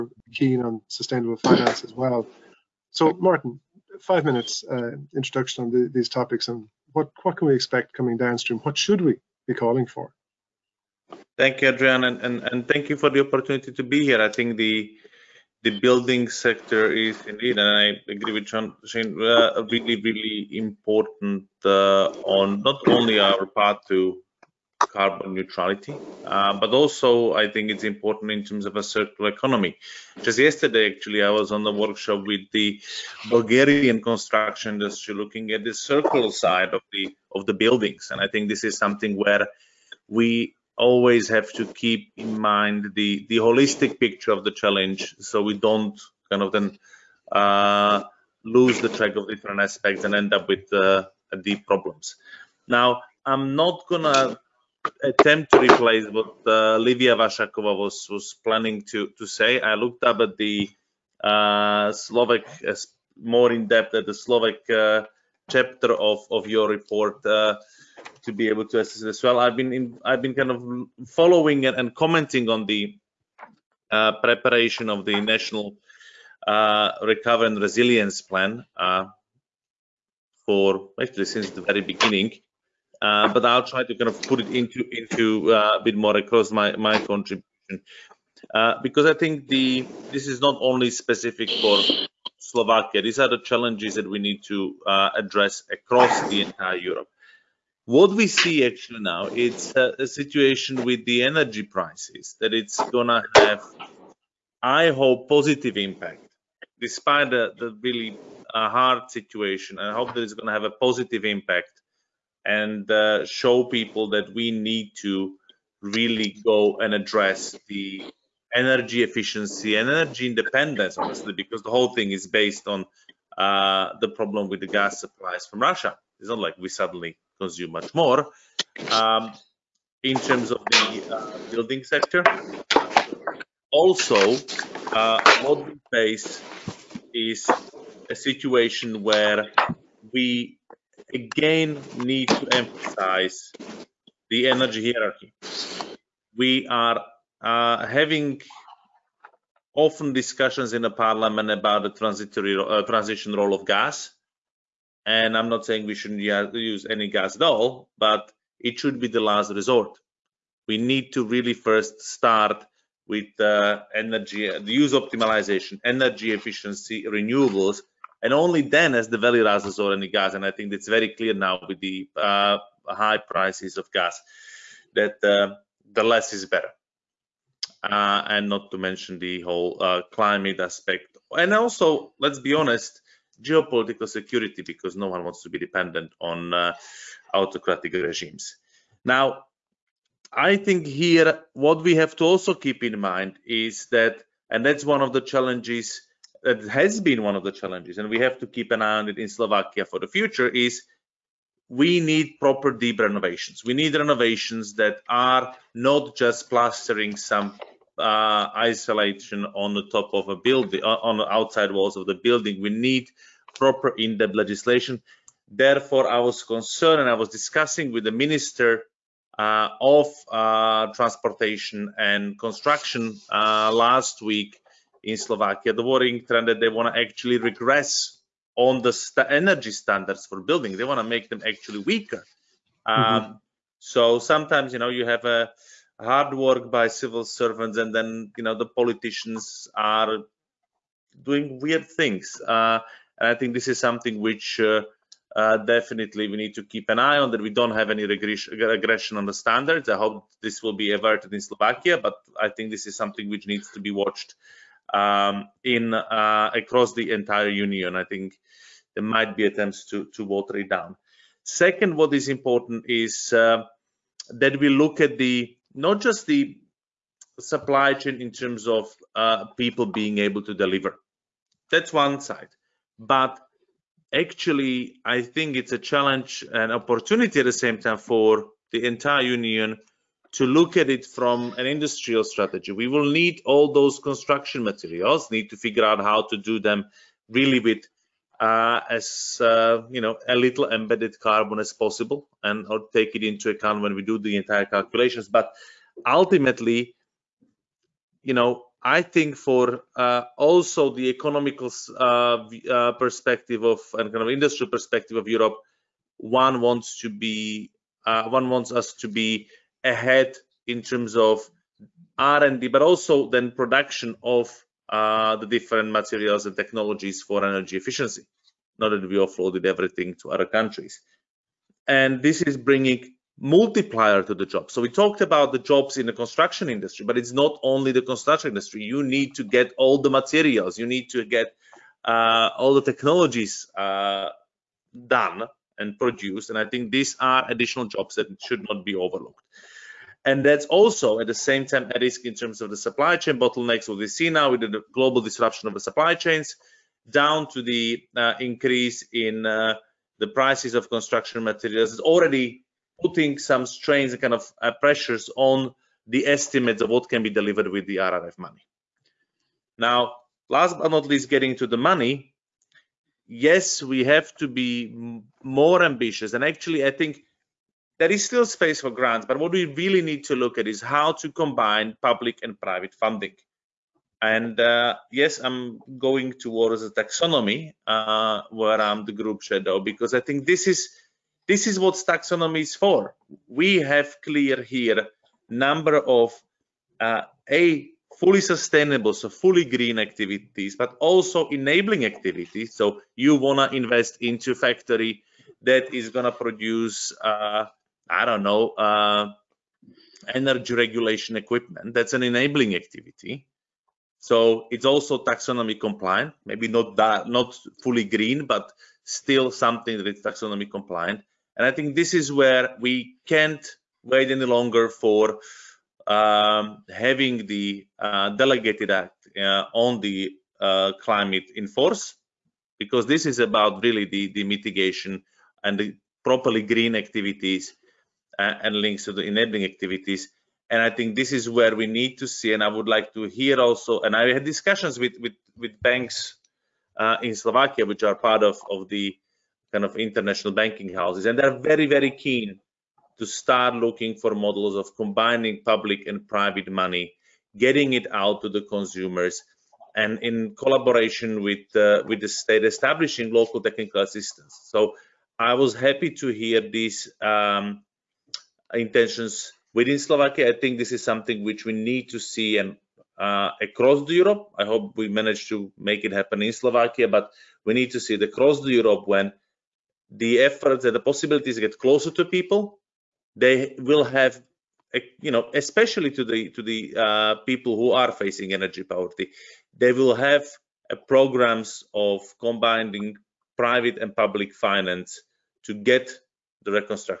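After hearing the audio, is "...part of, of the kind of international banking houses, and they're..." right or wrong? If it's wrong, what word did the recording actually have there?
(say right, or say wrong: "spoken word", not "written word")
right.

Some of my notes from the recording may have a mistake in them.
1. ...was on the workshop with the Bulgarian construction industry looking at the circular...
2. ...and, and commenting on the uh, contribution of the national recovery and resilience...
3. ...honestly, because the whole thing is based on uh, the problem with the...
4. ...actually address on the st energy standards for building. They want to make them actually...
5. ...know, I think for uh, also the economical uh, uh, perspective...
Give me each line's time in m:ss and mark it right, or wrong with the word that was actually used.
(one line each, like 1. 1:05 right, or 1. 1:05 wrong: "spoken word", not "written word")
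1. 0:31 right
2. 1:11 wrong: "preparation", not "contribution"
3. 2:00 right
4. 3:47 wrong: "regress", not "address"
5. 4:58 right.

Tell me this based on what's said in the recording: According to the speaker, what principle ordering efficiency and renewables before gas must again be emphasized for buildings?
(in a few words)
energy hierarchy.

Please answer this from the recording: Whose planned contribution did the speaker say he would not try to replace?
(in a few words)
Livia Vašáková.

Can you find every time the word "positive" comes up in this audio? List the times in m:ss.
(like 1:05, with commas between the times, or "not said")
1:45, 1:50.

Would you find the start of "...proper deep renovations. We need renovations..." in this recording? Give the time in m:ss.
3:22.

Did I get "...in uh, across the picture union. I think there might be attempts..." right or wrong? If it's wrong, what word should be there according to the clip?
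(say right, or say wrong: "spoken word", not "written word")
wrong: "entire", not "picture".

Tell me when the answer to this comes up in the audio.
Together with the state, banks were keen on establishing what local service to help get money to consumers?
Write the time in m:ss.
7:33.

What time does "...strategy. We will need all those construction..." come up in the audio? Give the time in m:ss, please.
4:42.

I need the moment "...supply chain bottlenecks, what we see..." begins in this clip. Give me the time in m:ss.
5:42.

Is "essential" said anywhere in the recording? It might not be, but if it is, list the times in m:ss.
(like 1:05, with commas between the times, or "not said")
not said.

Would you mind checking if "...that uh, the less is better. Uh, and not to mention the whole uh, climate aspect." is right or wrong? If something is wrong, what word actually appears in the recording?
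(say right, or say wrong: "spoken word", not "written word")
right.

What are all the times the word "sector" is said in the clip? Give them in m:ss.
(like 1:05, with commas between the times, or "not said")
0:16, 2:11.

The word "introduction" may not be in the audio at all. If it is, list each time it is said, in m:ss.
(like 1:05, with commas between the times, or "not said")
0:05.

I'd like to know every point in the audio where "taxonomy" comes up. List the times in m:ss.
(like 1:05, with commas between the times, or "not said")
6:16, 6:21, 6:45, 6:50.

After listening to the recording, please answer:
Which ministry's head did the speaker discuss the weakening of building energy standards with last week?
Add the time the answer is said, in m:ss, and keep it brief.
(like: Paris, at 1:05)
Transportation and Construction, at 3:40.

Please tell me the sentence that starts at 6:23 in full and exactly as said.
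We have clear here number of uh, a fully sustainable, so fully green activities, but also enabling activities.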